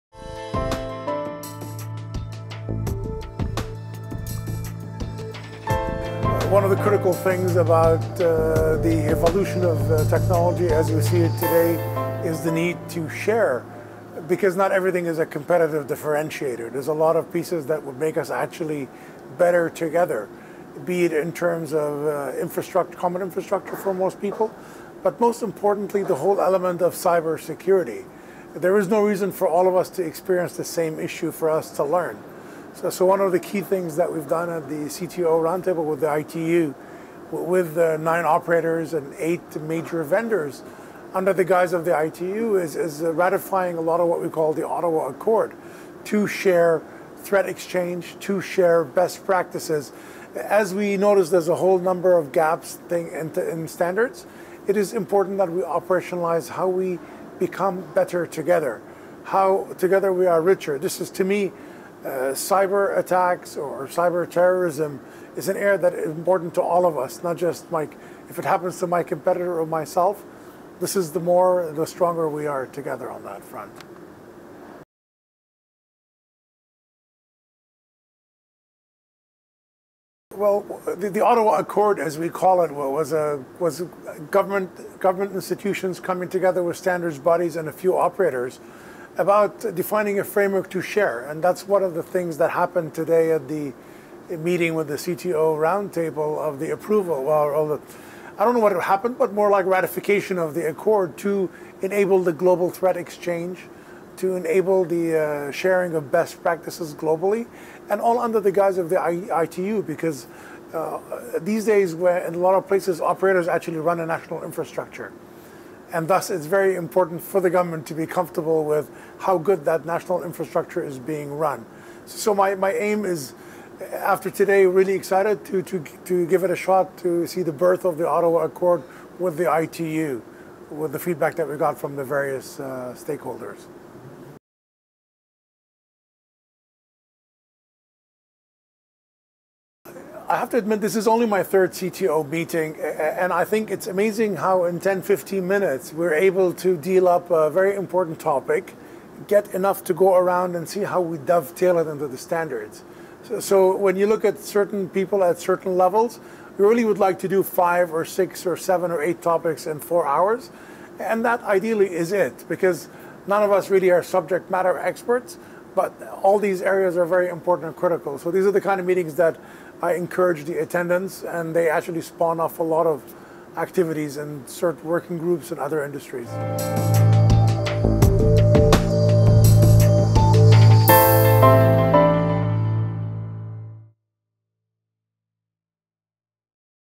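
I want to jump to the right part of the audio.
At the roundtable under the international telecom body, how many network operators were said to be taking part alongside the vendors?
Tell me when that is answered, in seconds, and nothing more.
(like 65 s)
37 s.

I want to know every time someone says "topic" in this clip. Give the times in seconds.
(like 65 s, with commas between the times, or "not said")
148 s, 159 s.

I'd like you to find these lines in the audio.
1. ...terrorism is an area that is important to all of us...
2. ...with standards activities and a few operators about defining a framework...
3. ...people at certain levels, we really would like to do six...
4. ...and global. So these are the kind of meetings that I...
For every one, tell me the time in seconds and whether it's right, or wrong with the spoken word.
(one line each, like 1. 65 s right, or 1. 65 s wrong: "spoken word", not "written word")
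1. 64 s right
2. 86 s wrong: "bodies", not "activities"
3. 154 s wrong: "five", not "six"
4. 167 s wrong: "critical", not "global".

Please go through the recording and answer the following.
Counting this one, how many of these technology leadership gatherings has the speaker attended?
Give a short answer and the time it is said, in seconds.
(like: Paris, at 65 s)
third, at 141 s.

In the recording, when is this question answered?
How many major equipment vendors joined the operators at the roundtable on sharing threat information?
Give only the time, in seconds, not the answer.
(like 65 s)
39 s.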